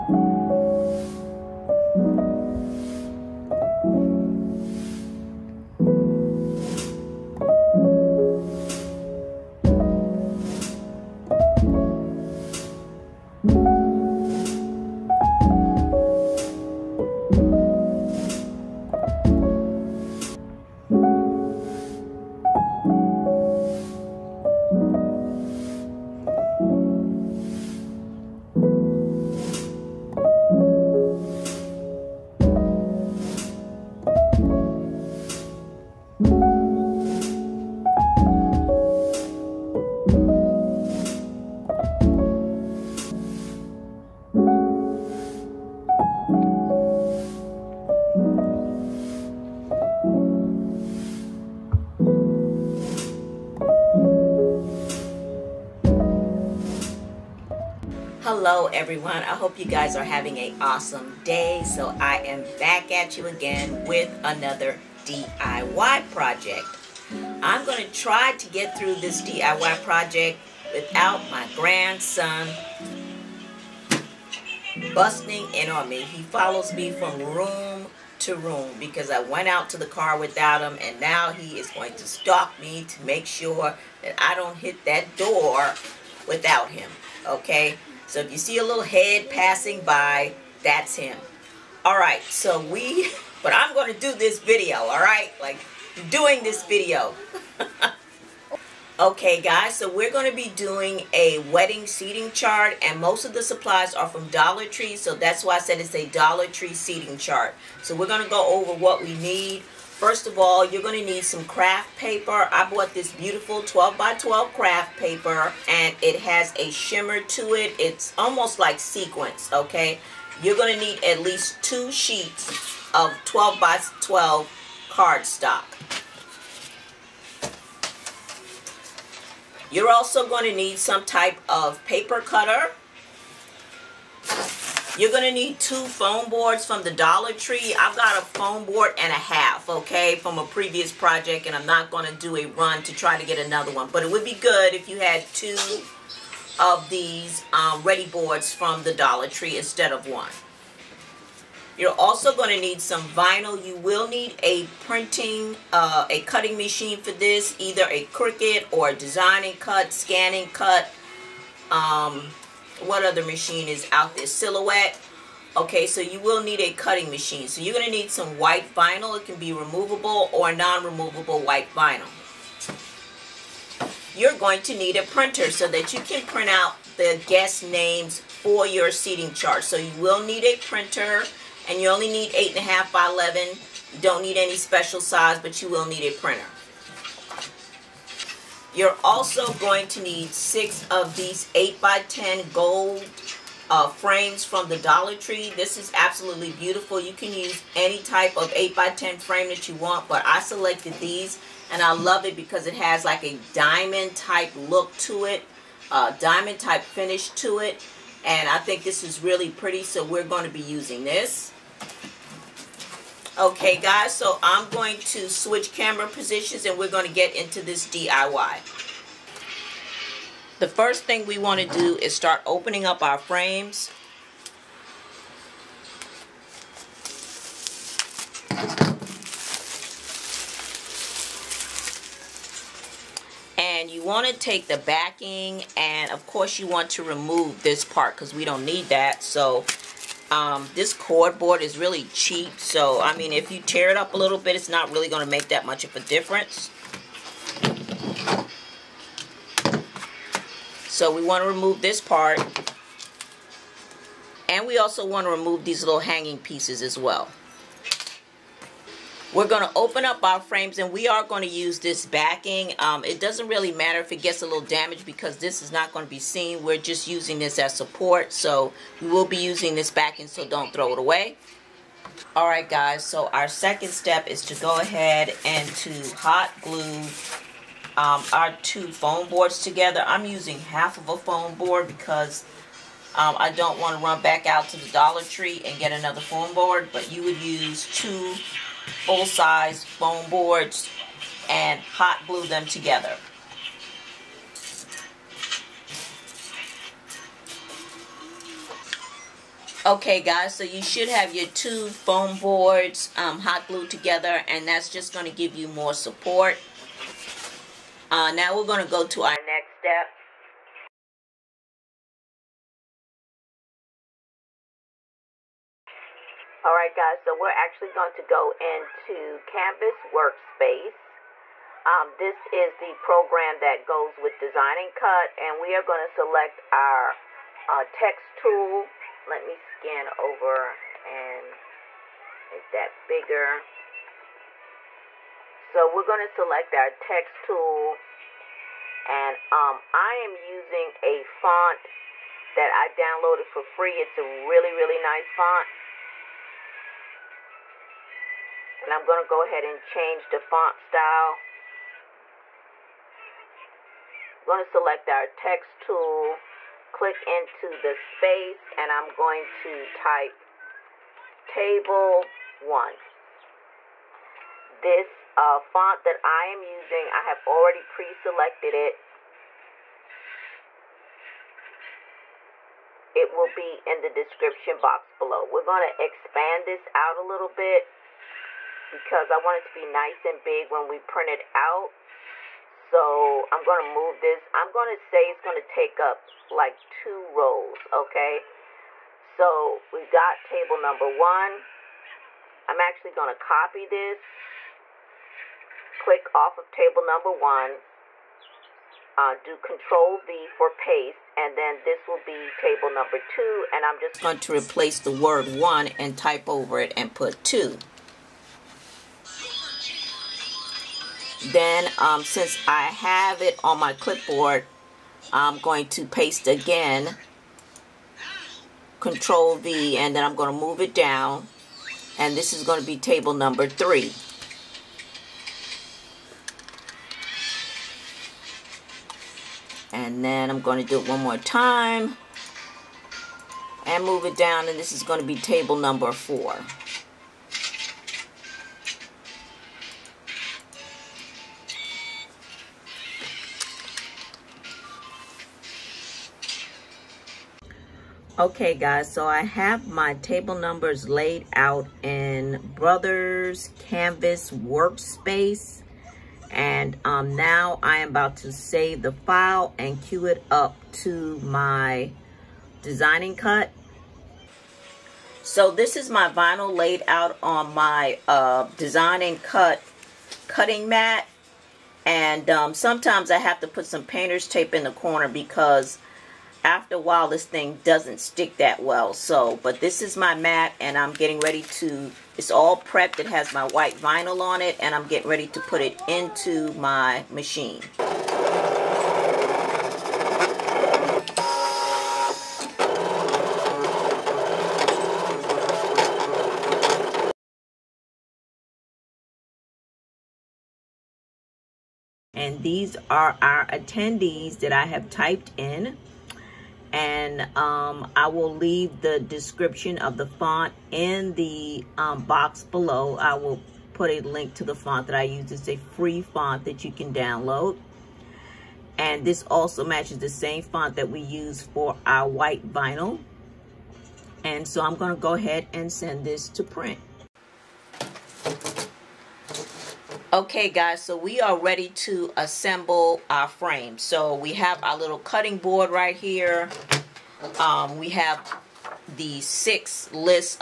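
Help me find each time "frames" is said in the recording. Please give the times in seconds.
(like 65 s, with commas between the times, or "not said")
193 s, 199 s, 223 s, 260 s, 533 s.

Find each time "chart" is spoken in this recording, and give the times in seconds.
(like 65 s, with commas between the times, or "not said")
102 s, 107 s, 179 s.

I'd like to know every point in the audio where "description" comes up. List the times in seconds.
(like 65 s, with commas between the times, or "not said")
374 s, 509 s.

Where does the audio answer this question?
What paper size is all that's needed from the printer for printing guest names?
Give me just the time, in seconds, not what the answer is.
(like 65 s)
182 s.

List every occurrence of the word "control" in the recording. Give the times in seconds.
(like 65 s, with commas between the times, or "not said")
399 s, 418 s.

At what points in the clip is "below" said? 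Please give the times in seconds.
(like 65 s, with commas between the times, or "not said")
375 s, 512 s.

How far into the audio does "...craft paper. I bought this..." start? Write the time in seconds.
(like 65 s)
111 s.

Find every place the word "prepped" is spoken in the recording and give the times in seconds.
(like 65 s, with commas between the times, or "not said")
482 s.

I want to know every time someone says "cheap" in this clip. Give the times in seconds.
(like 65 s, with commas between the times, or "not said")
242 s.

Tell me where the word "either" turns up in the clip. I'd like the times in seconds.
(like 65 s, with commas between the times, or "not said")
157 s.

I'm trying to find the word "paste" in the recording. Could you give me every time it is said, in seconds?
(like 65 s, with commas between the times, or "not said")
400 s, 416 s.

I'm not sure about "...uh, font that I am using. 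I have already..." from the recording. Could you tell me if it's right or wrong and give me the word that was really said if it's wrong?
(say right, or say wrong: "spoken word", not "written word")
right.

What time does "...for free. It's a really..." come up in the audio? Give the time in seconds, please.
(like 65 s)
343 s.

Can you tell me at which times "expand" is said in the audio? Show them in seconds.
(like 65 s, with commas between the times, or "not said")
376 s.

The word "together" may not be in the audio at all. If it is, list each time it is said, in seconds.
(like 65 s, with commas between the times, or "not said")
279 s, 292 s, 303 s.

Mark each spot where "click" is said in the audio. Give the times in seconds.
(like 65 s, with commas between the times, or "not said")
356 s, 395 s.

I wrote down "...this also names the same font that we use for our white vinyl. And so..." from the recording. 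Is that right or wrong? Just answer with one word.
wrong.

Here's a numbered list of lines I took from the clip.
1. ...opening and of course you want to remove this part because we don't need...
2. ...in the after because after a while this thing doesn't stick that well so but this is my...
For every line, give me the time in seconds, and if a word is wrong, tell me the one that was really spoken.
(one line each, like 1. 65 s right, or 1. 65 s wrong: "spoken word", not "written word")
1. 234 s wrong: "backing", not "opening"
2. 474 s wrong: "corner", not "after".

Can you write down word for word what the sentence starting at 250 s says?
So we want to remove this part.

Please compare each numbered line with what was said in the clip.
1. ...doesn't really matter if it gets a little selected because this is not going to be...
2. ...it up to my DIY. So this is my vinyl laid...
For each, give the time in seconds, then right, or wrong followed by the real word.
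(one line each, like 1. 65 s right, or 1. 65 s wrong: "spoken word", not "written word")
1. 263 s wrong: "damaged", not "selected"
2. 460 s wrong: "DesignNCut", not "DIY".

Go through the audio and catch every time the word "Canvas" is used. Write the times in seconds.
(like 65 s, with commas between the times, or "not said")
319 s, 453 s.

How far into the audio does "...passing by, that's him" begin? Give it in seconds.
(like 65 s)
89 s.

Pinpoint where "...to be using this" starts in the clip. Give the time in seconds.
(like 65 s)
210 s.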